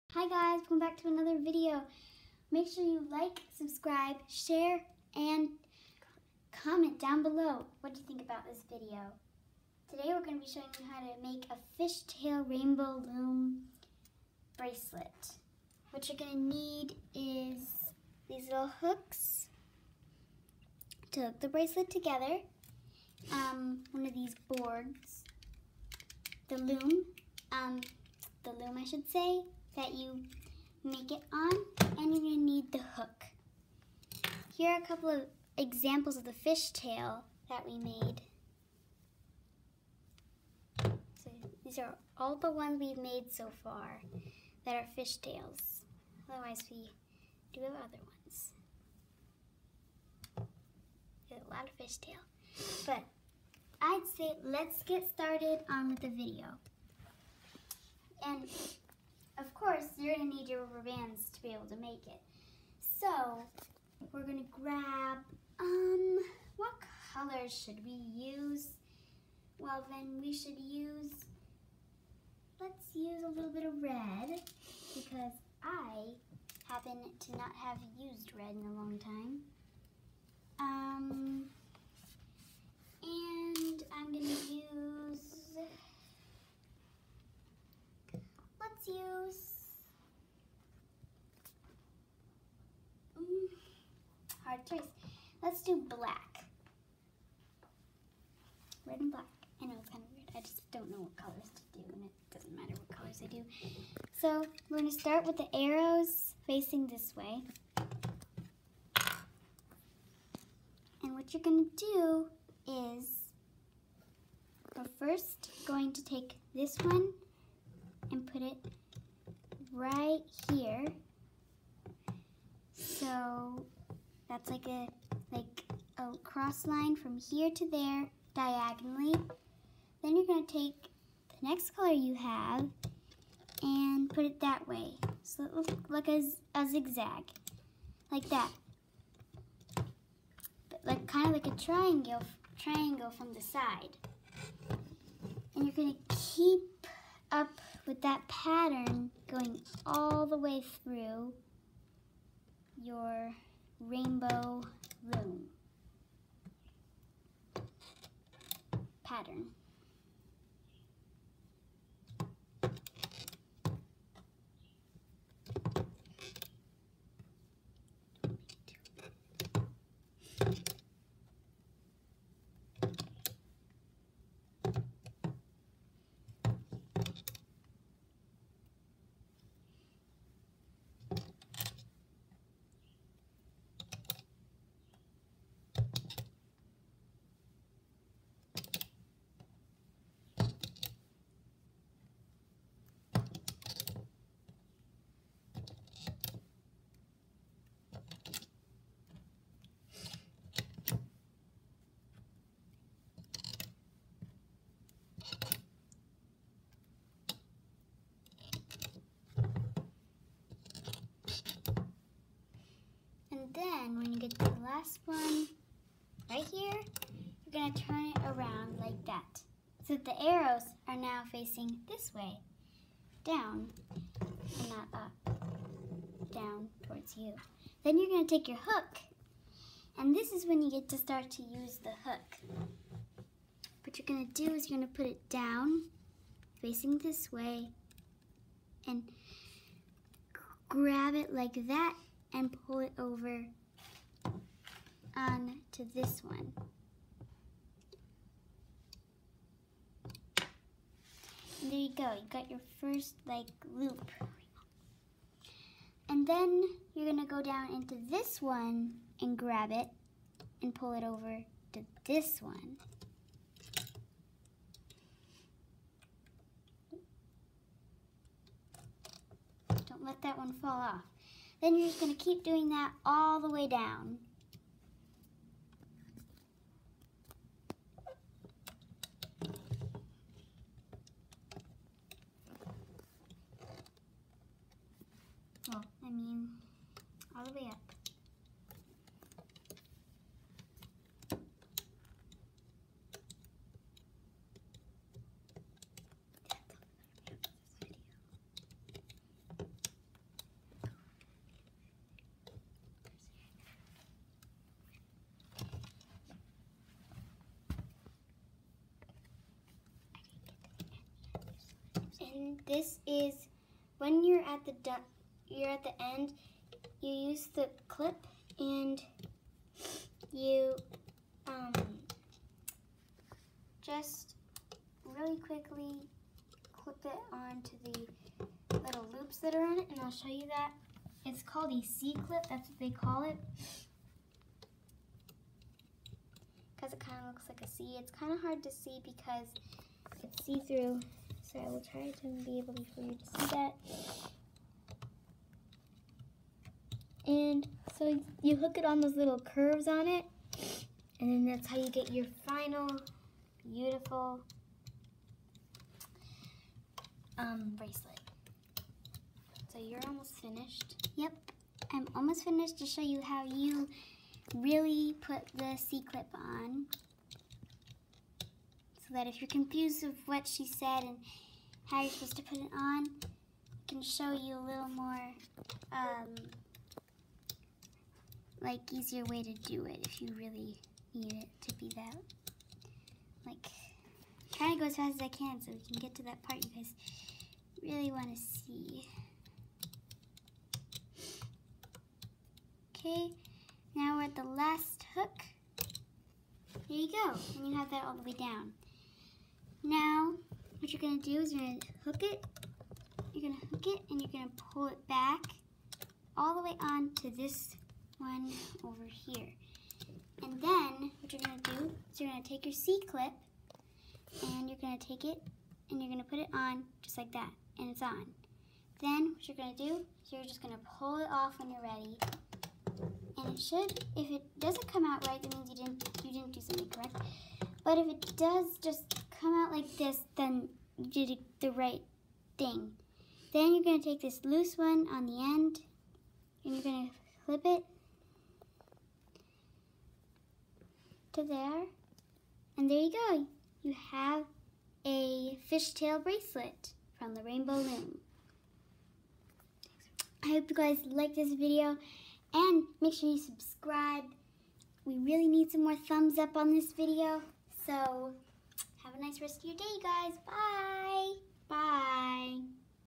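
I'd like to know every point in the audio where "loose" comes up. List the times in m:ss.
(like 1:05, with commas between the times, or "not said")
7:14.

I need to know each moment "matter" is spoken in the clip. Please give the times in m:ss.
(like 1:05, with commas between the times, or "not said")
1:42.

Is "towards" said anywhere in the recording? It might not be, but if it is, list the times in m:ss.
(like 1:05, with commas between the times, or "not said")
3:46.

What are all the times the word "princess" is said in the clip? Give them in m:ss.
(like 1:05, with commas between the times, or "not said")
not said.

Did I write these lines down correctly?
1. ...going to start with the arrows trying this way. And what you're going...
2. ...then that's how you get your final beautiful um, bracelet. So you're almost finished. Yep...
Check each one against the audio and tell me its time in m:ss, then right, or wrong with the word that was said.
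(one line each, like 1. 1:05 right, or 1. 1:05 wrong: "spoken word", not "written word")
1. 1:44 wrong: "facing", not "trying"
2. 5:51 right.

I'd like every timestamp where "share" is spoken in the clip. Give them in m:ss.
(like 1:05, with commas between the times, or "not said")
0:04.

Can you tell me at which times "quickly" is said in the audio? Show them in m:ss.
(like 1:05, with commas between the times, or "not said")
5:25.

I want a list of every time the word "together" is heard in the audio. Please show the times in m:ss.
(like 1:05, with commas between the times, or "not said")
0:21.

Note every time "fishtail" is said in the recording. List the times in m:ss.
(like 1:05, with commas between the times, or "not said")
0:11, 0:36, 0:44, 0:51, 7:25.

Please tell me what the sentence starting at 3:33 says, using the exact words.
And then when you get to the last one, right here, you're going to turn it around like that.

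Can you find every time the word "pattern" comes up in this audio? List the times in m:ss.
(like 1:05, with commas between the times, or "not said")
2:28, 2:39.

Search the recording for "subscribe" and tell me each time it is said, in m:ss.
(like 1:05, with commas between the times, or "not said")
0:03, 7:33.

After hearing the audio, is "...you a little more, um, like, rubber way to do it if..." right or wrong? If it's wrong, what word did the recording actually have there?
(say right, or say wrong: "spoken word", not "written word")
wrong: "easier", not "rubber".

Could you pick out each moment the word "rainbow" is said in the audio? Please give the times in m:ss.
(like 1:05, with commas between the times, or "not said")
0:12, 2:33, 7:27.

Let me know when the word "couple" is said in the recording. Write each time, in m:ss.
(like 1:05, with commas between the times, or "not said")
0:34.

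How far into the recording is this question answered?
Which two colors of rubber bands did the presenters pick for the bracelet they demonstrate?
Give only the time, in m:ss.
1:38.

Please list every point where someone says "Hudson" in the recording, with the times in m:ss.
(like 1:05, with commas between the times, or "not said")
not said.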